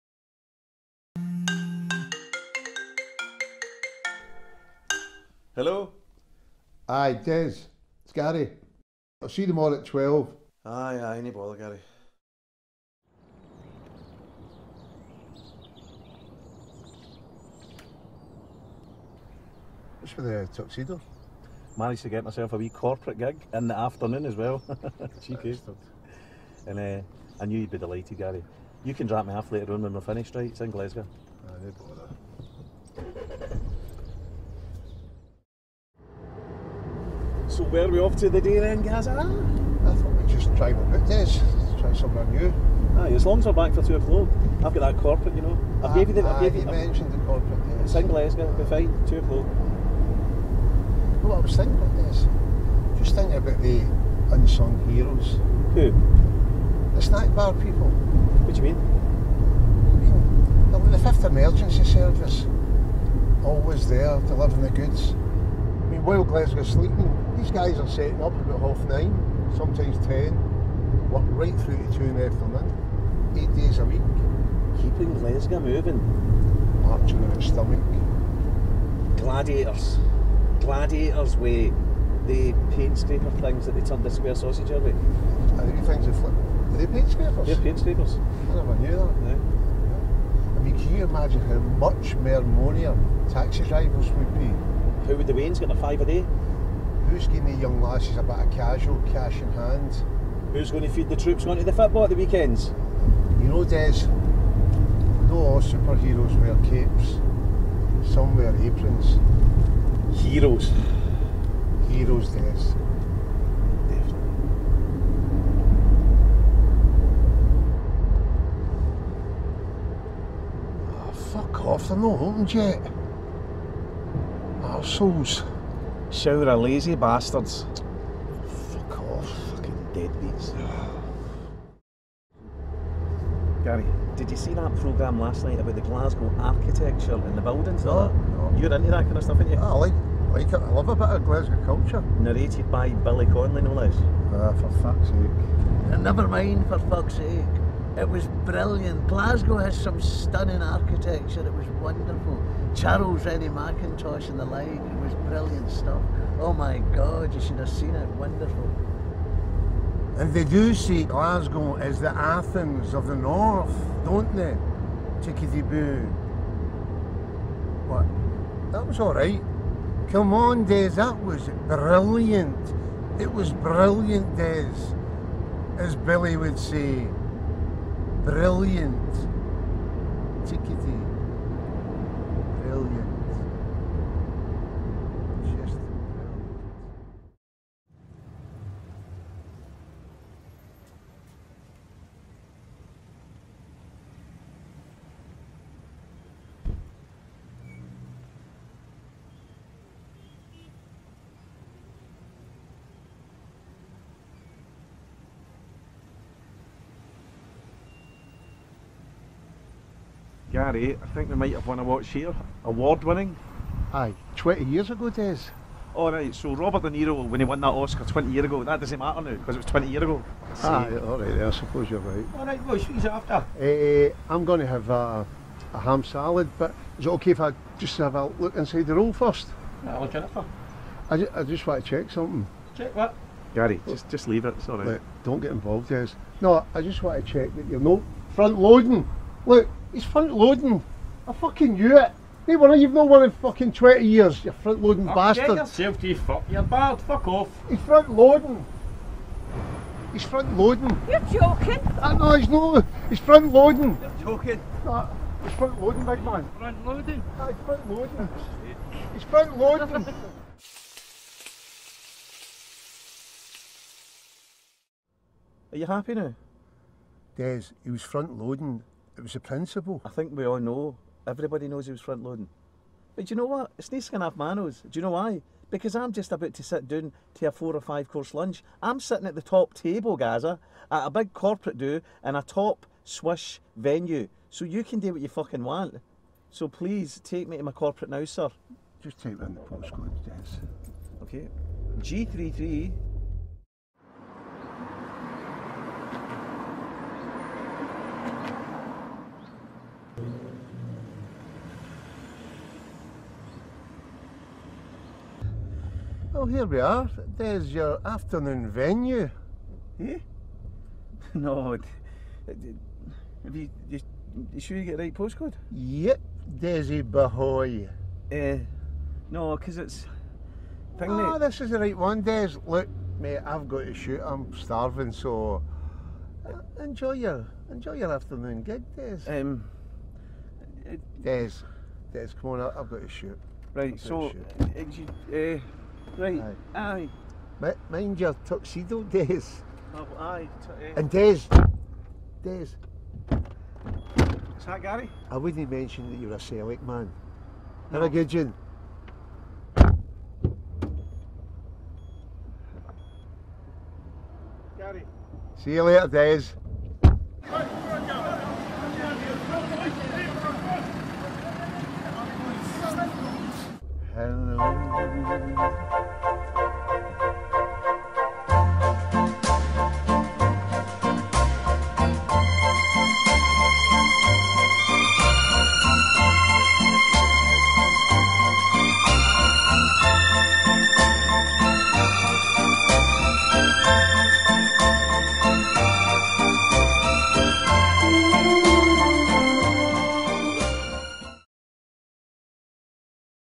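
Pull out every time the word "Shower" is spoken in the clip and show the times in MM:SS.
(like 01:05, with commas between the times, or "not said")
02:06.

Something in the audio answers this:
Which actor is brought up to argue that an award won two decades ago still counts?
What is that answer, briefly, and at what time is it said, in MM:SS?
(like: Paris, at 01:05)
Robert De Niro, at 03:36.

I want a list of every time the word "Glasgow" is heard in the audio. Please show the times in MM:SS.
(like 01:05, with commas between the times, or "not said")
00:30, 01:06, 01:15, 02:15, 02:21, 02:29, 02:41.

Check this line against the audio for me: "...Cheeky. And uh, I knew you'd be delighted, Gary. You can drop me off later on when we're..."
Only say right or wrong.
right.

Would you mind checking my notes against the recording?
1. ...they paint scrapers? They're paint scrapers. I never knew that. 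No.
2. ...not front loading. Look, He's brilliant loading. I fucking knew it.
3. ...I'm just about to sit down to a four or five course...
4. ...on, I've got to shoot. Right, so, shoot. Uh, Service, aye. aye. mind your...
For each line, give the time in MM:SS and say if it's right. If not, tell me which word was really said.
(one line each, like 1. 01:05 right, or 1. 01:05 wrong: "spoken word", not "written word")
1. 01:26 right
2. 03:57 wrong: "front", not "brilliant"
3. 04:35 right
4. 05:32 wrong: "Right", not "Service".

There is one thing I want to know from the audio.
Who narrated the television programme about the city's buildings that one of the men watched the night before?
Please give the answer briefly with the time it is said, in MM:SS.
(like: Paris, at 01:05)
Billy Connolly, at 02:22.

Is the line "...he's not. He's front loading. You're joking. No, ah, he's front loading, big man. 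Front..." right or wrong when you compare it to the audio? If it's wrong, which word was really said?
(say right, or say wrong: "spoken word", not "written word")
right.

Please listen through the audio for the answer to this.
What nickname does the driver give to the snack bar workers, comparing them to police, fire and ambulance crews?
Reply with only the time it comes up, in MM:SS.
01:00.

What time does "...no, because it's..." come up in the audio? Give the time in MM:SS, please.
05:19.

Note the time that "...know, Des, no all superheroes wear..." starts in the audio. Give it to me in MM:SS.
01:43.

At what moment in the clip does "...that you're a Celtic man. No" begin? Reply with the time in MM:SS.
05:46.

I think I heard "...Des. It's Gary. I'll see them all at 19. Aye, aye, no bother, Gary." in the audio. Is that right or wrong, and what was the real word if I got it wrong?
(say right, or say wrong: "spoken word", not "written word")
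wrong: "12", not "19".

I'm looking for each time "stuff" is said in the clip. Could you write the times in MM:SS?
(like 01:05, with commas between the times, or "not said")
02:19, 02:35.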